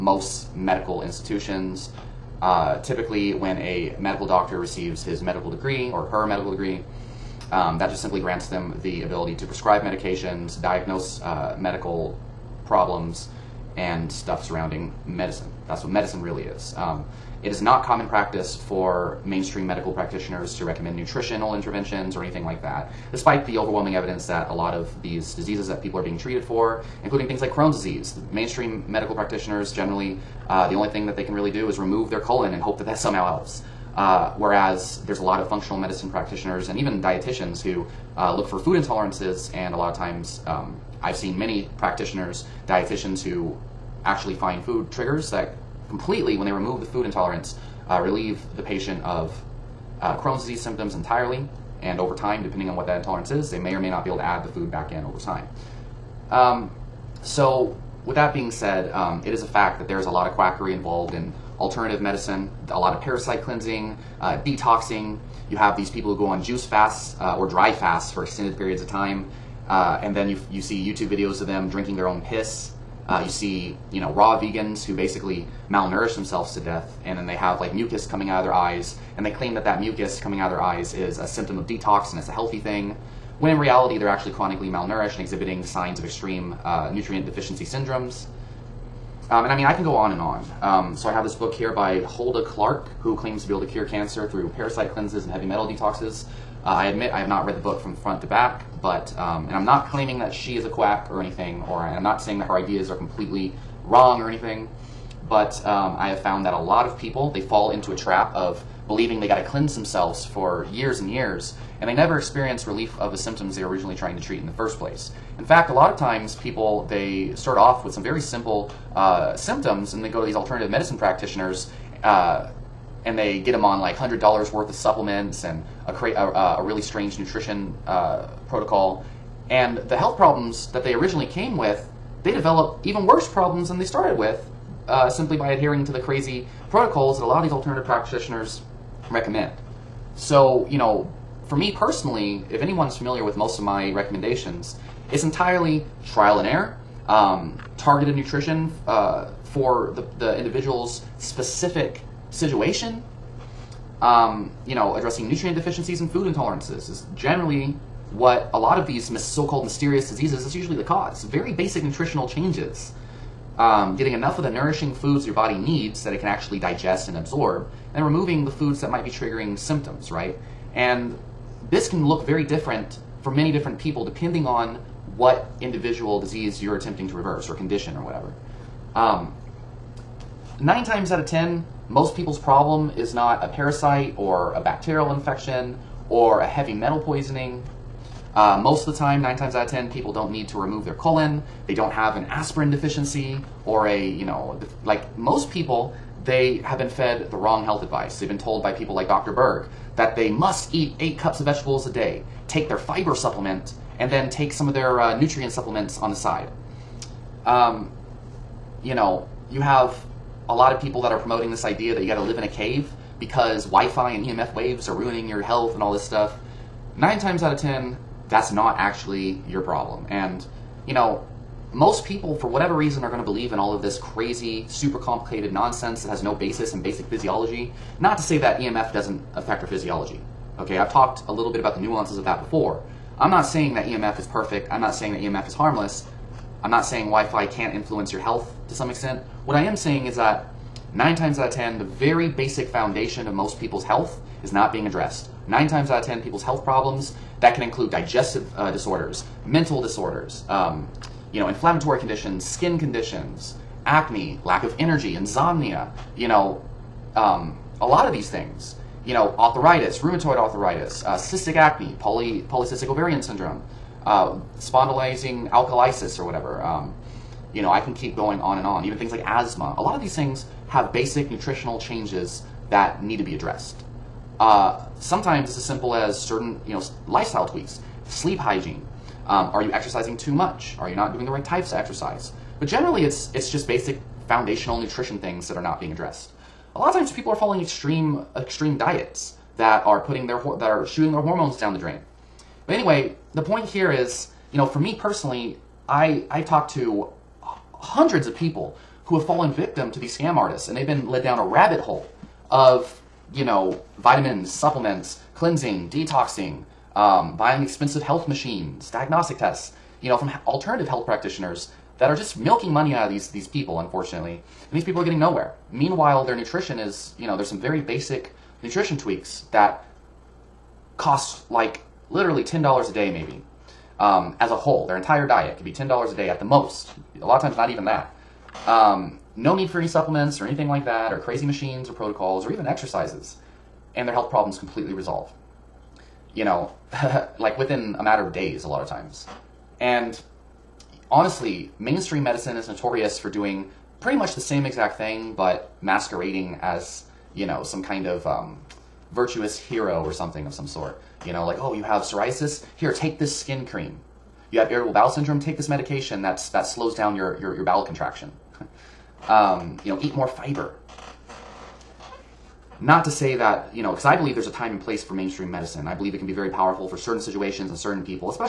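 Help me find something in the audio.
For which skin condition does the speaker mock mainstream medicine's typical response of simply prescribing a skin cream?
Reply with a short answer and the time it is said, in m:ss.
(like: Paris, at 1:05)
psoriasis, at 5:52.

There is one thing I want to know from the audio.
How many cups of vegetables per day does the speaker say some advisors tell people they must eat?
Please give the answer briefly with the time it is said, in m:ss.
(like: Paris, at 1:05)
8, at 3:21.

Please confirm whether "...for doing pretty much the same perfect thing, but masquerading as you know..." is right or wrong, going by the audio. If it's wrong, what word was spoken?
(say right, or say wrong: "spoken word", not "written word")
wrong: "exact", not "perfect".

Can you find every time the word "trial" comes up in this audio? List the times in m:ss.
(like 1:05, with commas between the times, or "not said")
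2:26.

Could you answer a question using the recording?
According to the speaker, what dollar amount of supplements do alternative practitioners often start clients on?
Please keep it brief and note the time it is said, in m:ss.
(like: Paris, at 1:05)
$100, at 2:03.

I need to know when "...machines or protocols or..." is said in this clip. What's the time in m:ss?
5:31.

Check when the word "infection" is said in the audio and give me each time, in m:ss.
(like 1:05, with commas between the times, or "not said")
3:05.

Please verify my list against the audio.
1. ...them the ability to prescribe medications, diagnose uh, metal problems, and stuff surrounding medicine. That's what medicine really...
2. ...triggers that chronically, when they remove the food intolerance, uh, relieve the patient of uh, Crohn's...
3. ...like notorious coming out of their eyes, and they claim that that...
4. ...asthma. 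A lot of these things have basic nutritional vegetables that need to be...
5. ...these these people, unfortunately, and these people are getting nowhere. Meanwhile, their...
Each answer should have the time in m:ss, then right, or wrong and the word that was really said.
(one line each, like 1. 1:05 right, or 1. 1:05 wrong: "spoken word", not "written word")
1. 0:08 wrong: "medical", not "metal"
2. 0:44 wrong: "completely", not "chronically"
3. 1:17 wrong: "mucus", not "notorious"
4. 4:29 wrong: "changes", not "vegetables"
5. 5:13 right.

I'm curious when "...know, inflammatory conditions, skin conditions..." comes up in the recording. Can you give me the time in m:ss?
4:11.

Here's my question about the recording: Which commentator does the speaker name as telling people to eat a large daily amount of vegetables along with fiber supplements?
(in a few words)
Dr. Berg.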